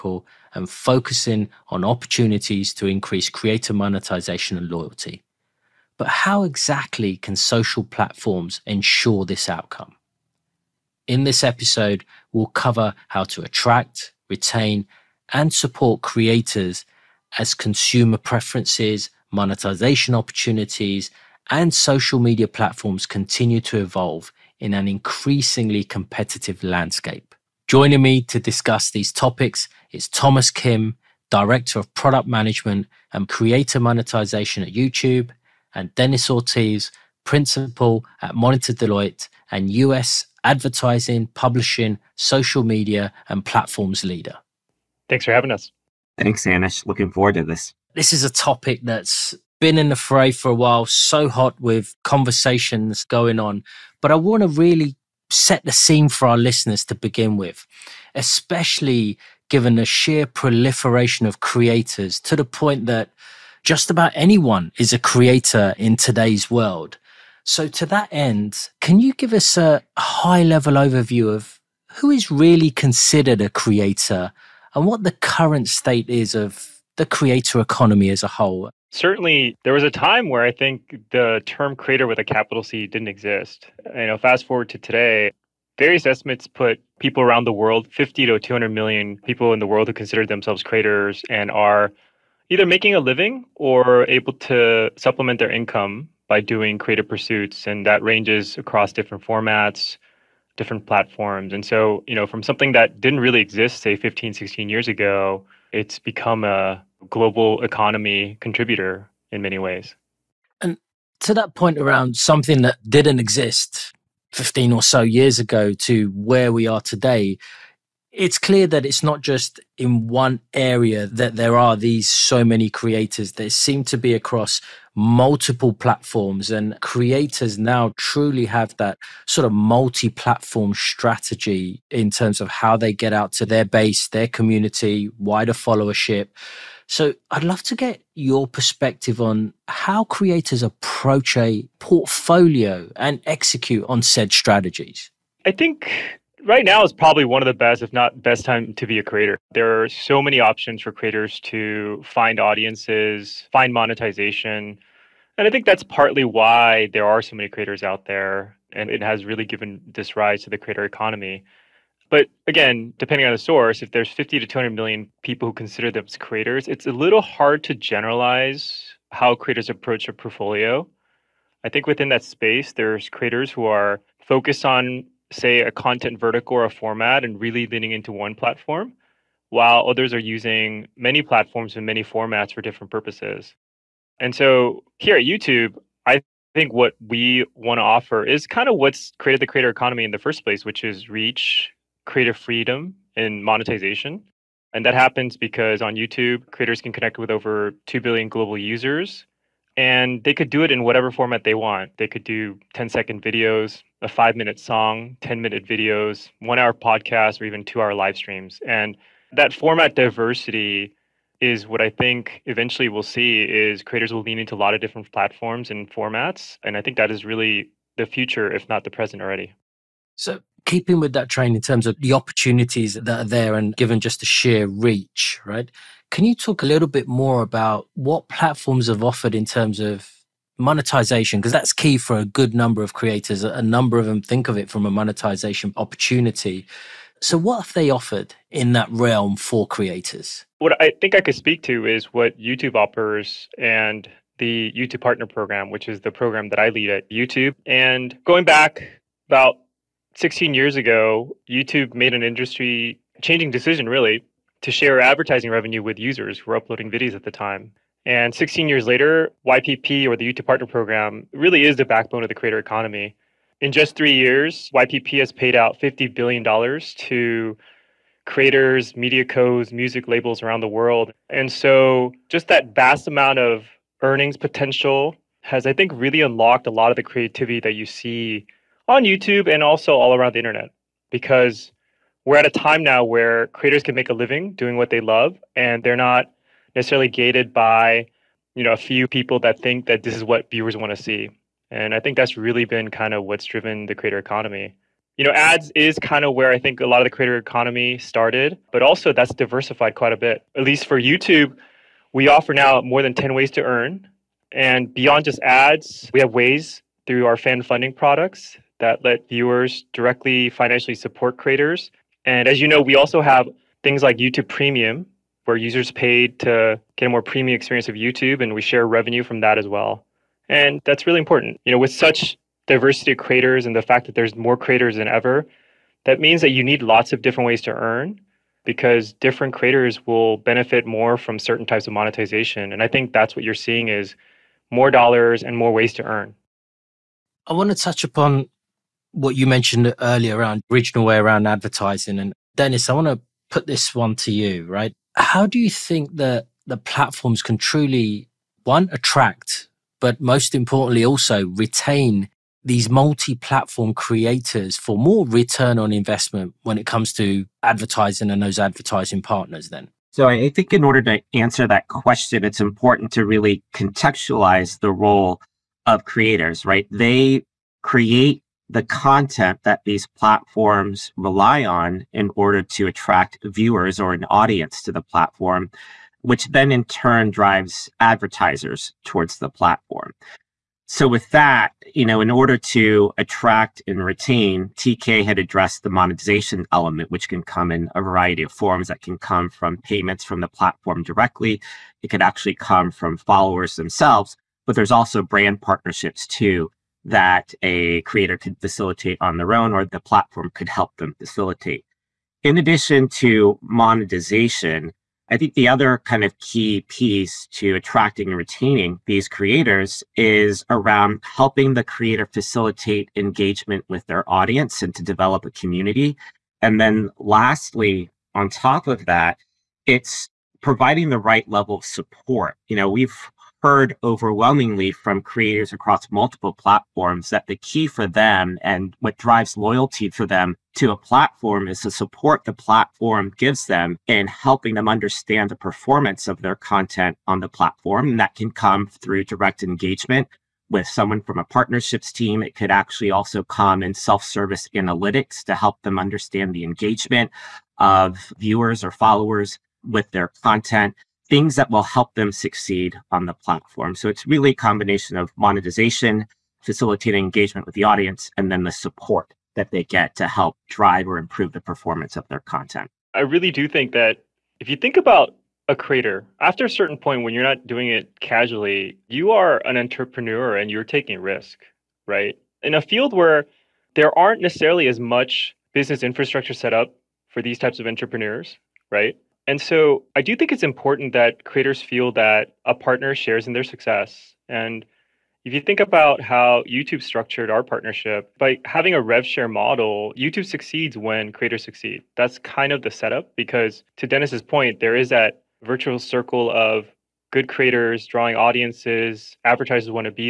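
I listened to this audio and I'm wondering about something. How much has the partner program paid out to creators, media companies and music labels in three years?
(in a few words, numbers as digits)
$50 billion.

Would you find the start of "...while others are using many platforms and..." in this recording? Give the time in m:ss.
2:59.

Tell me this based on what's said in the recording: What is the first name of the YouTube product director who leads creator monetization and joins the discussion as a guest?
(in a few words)
Thomas.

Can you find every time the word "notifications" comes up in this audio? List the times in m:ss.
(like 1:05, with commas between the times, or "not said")
not said.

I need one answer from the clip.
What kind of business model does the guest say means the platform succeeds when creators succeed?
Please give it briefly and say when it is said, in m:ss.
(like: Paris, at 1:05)
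rev share model, at 8:09.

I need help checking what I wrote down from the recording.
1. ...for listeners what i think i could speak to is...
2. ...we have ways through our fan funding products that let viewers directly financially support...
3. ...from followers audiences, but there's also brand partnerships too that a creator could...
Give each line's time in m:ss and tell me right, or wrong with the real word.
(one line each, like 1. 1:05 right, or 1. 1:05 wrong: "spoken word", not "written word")
1. 3:59 wrong: "creators", not "listeners"
2. 5:06 right
3. 6:32 wrong: "themselves", not "audiences".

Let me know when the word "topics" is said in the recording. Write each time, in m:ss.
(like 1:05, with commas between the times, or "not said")
0:29, 0:48.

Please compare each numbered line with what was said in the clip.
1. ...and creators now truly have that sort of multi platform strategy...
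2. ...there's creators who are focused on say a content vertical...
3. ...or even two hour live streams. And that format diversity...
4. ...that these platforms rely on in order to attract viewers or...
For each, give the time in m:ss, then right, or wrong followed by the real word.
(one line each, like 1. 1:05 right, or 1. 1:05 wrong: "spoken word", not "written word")
1. 2:06 right
2. 2:52 right
3. 3:27 right
4. 6:09 right.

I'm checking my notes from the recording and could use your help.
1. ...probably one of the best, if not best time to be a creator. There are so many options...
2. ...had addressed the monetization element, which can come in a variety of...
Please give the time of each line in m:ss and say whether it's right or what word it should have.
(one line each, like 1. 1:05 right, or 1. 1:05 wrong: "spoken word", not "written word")
1. 2:26 right
2. 6:25 right.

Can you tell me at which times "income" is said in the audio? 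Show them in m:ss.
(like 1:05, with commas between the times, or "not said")
1:35.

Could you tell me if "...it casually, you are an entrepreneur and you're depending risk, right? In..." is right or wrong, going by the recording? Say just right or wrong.
wrong.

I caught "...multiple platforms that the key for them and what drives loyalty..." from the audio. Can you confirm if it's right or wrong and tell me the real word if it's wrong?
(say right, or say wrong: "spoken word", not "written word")
right.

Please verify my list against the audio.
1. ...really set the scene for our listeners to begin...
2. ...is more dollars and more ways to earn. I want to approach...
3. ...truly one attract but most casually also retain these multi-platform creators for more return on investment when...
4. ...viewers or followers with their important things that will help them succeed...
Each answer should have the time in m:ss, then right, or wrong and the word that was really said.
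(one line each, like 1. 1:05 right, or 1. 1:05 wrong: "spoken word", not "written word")
1. 0:54 right
2. 5:33 wrong: "touch", not "approach"
3. 5:47 wrong: "importantly", not "casually"
4. 7:28 wrong: "content", not "important".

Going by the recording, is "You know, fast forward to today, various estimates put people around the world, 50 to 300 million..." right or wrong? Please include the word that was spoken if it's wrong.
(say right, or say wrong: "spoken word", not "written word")
wrong: "200", not "300".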